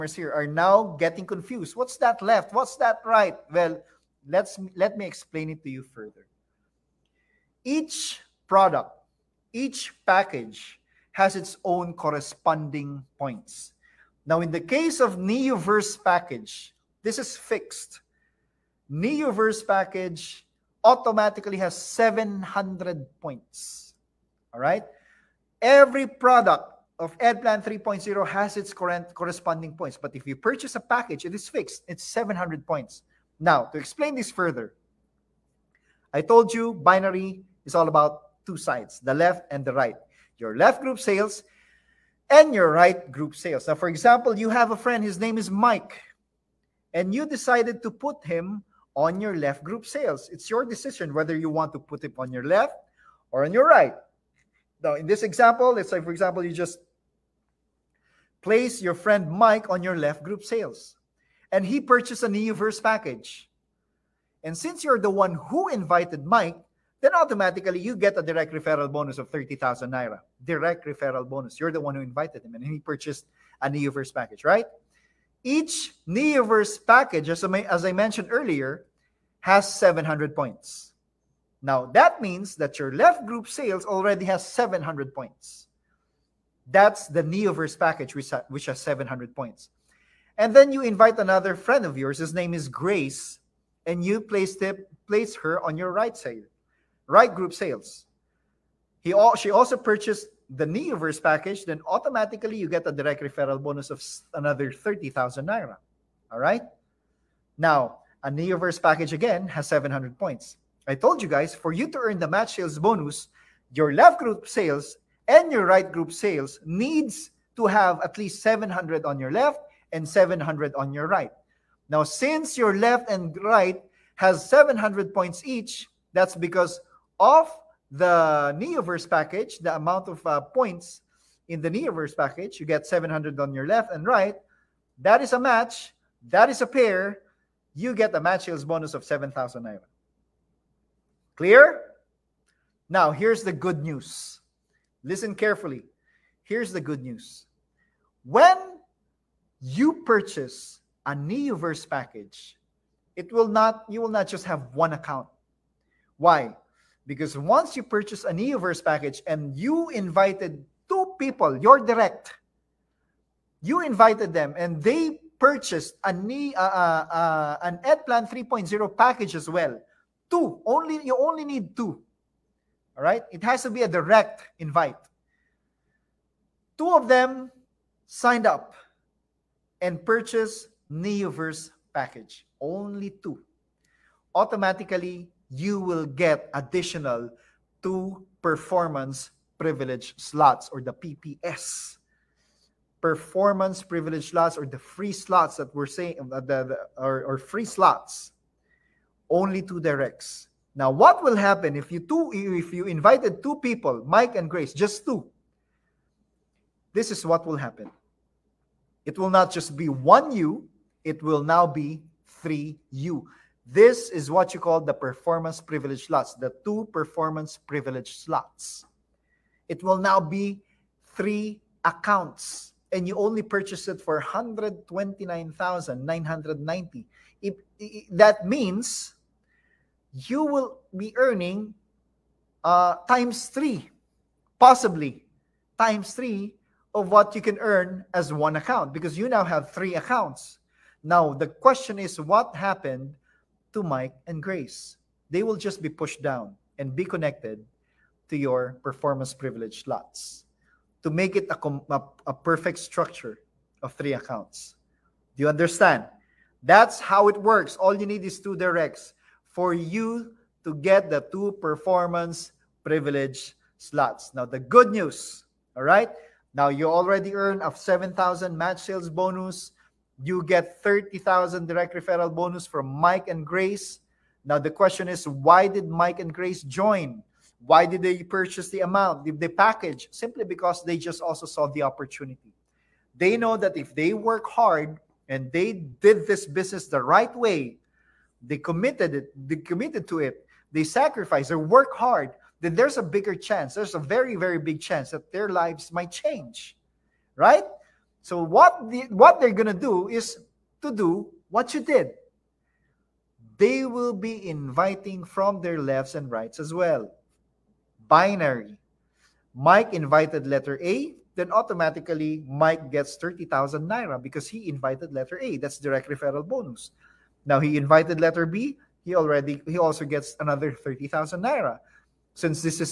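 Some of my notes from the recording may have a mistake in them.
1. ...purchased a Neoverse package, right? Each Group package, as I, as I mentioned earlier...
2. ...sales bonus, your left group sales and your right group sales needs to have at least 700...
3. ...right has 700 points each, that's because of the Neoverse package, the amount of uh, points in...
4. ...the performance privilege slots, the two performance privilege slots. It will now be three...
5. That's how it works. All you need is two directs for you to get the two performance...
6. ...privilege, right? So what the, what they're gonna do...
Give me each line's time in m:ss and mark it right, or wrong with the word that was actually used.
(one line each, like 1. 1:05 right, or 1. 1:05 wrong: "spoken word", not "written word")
1. 1:12 wrong: "Neoverse", not "Group"
2. 1:52 right
3. 2:03 right
4. 3:34 right
5. 4:16 right
6. 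4:56 wrong: "change", not "privilege".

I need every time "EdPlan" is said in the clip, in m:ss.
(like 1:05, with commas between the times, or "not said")
0:27, 2:47.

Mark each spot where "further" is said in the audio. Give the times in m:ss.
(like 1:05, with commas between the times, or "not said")
0:05, 0:34.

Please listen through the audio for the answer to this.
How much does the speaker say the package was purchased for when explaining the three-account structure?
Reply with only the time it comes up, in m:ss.
3:44.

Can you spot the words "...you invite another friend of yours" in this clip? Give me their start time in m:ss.
1:30.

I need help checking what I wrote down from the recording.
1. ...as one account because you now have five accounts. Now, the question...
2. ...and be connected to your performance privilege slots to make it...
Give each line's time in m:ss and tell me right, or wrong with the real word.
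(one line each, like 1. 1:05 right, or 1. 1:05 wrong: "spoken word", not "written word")
1. 3:58 wrong: "three", not "five"
2. 4:06 right.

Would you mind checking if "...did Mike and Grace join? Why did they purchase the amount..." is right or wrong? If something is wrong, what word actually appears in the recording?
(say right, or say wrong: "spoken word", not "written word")
right.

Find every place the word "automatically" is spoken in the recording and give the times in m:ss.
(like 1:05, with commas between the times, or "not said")
0:20, 1:07, 1:41, 3:04, 5:11.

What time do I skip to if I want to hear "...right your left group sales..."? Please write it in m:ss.
0:39.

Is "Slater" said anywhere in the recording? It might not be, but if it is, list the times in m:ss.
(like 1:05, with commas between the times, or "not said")
not said.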